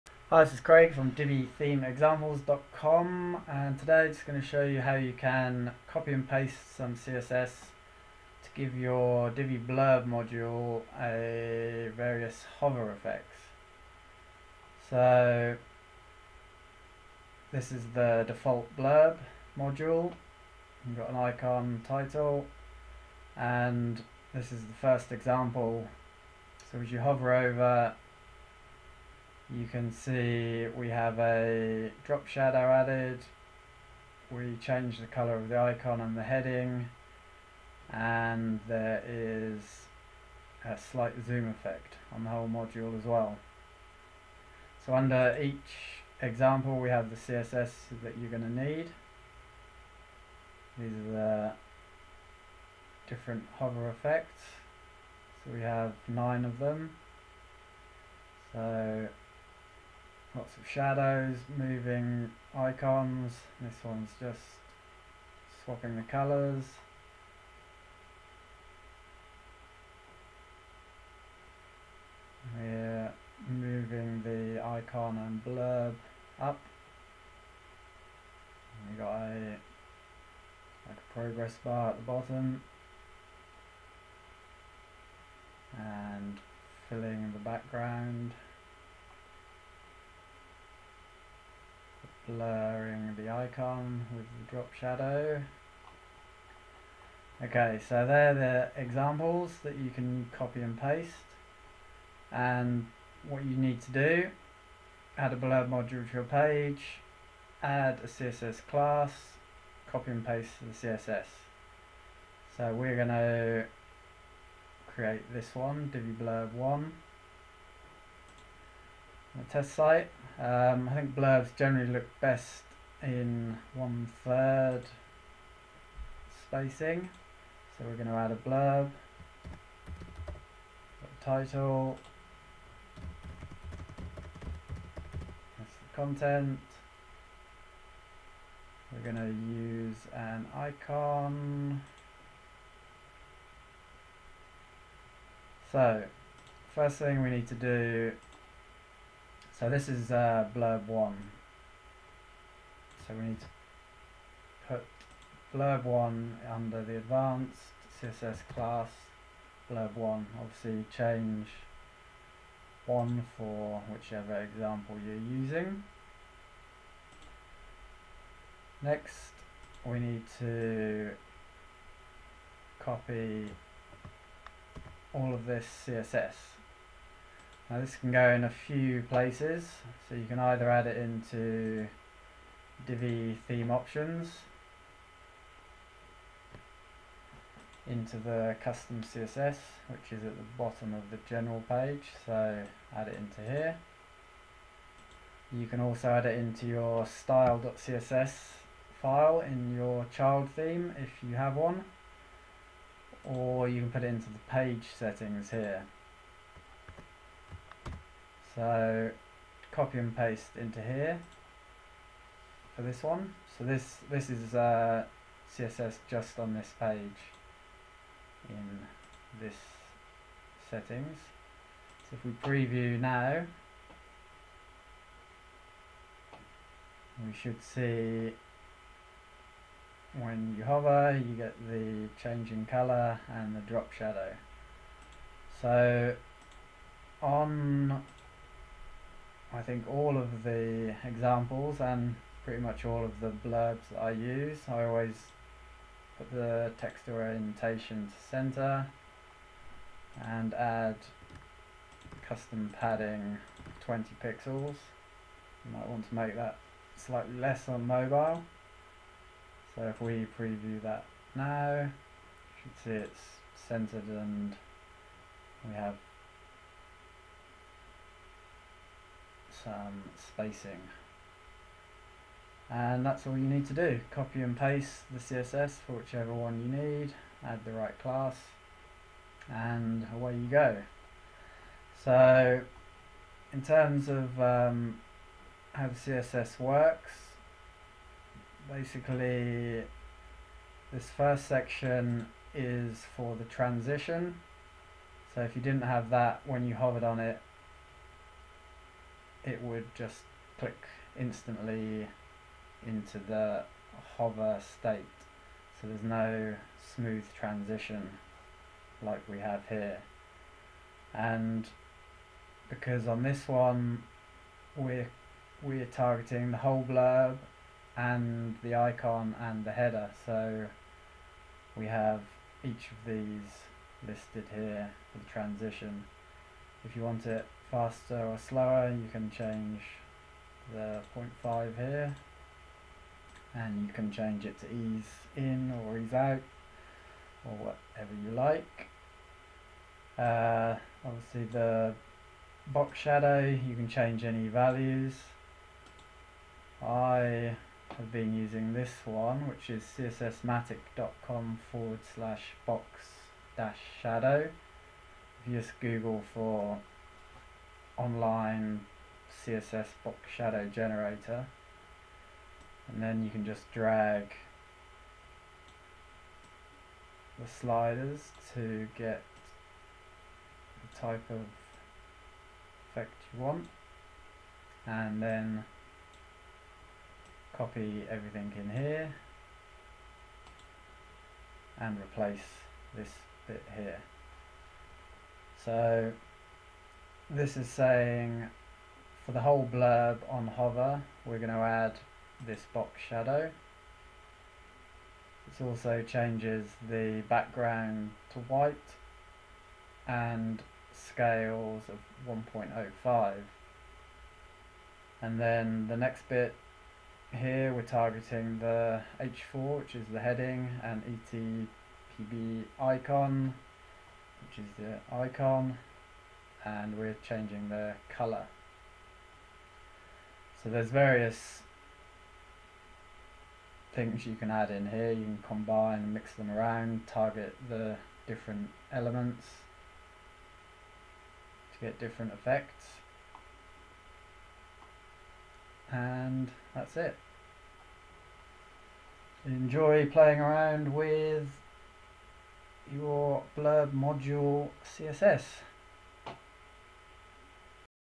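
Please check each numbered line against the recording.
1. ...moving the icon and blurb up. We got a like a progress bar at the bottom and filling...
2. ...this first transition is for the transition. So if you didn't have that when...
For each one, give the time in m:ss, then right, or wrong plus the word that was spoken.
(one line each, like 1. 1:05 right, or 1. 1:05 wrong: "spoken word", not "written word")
1. 1:13 right
2. 4:50 wrong: "section", not "transition".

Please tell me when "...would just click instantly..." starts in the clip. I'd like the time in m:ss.
4:59.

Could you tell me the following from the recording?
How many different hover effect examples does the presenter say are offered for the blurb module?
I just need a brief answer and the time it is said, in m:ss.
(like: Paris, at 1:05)
9, at 0:56.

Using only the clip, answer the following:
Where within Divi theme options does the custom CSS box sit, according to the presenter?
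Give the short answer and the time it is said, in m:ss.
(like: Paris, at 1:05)
bottom of the general page, at 3:10.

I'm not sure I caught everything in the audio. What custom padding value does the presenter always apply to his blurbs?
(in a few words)
20 pixels.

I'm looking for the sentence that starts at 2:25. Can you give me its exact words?
So, first thing we need to do so this is uh, blurb 1.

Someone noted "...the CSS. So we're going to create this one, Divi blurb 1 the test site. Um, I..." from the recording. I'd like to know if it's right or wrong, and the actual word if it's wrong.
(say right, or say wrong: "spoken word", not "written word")
right.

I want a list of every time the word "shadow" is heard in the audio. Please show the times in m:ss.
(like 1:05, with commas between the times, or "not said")
0:32, 1:00, 1:34, 3:53, 5:42, 5:54, 6:00, 6:33.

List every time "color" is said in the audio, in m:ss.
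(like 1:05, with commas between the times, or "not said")
0:35, 1:06, 3:52, 6:58.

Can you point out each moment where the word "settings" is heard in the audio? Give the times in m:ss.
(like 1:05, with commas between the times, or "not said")
3:24, 3:40.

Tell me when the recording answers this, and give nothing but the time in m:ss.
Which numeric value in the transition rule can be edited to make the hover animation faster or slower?
5:31.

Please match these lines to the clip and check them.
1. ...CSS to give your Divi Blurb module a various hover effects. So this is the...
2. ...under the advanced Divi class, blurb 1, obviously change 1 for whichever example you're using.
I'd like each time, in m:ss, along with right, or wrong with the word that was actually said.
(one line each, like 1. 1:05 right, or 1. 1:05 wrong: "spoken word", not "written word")
1. 0:06 right
2. 2:36 wrong: "CSS", not "Divi".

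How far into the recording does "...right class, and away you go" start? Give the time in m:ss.
4:37.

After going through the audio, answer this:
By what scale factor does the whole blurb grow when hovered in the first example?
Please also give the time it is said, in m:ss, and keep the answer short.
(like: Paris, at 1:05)
1.05, at 6:42.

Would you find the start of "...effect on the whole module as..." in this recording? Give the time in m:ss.
0:41.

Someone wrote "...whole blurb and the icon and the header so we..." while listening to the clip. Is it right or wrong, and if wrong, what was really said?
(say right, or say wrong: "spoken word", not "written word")
right.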